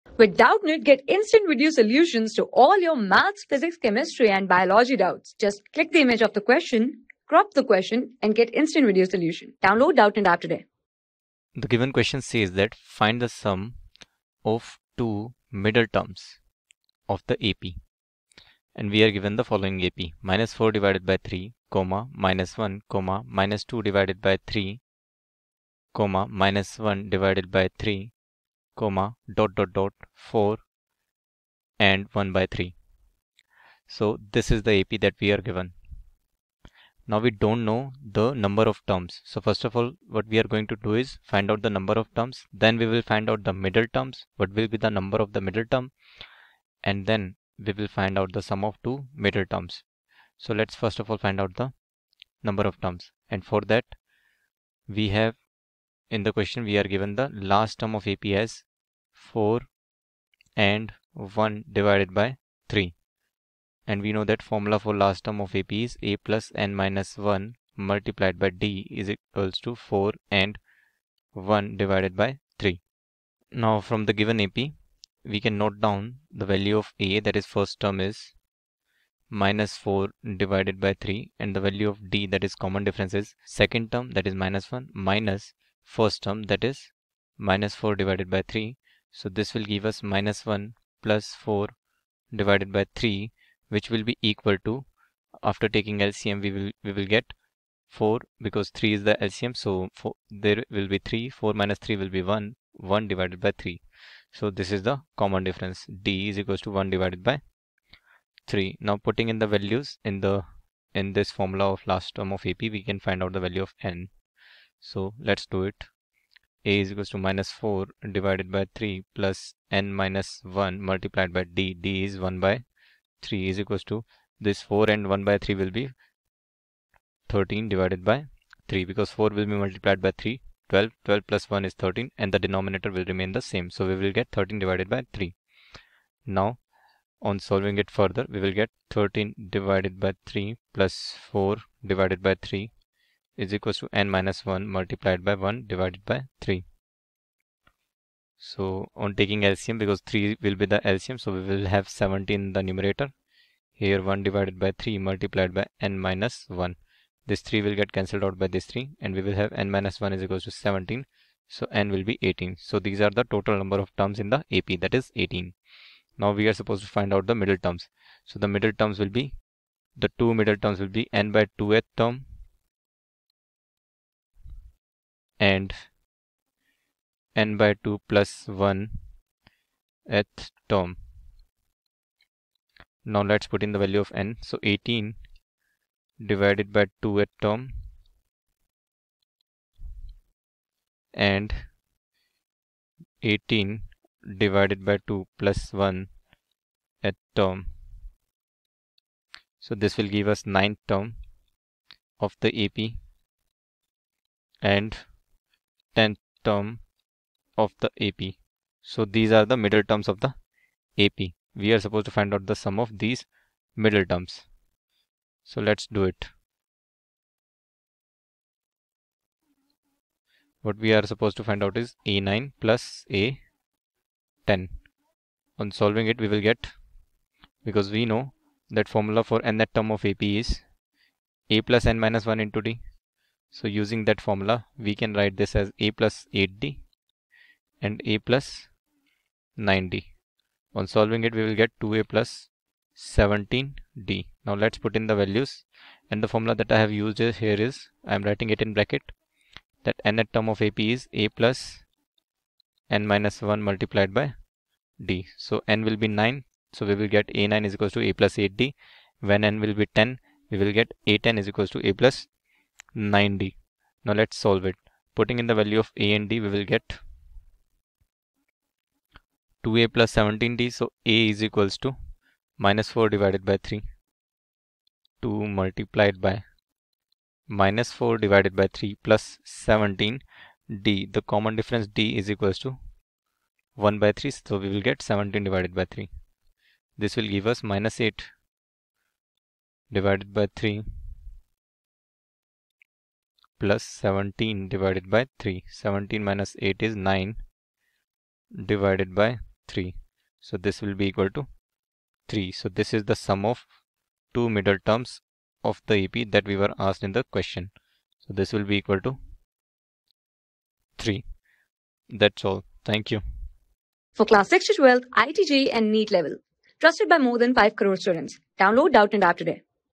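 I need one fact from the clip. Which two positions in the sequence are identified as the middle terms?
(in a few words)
9th and 10th.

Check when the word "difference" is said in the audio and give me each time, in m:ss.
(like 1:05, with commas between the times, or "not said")
1:22, 1:45, 4:41.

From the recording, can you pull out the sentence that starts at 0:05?
Just click the image of the question, crop the question, and get instant video solution.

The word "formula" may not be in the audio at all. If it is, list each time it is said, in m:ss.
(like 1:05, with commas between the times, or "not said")
1:04, 1:51, 3:48, 3:54, 4:06.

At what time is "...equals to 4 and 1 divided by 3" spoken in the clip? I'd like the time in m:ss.
1:09.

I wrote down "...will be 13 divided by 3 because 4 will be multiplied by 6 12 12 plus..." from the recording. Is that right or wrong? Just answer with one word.
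wrong.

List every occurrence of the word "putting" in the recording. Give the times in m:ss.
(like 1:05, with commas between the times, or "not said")
1:48, 4:25.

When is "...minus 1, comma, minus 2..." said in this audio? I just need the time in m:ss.
0:22.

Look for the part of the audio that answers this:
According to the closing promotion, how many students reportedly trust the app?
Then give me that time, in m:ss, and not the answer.
5:17.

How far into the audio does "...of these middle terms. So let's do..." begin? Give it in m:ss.
3:32.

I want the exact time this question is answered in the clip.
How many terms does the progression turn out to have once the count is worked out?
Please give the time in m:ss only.
2:41.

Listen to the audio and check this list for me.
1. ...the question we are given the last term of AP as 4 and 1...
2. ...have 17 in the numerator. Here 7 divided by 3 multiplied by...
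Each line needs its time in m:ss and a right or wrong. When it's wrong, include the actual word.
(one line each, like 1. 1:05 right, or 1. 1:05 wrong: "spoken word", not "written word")
1. 0:56 right
2. 2:31 wrong: "1", not "7".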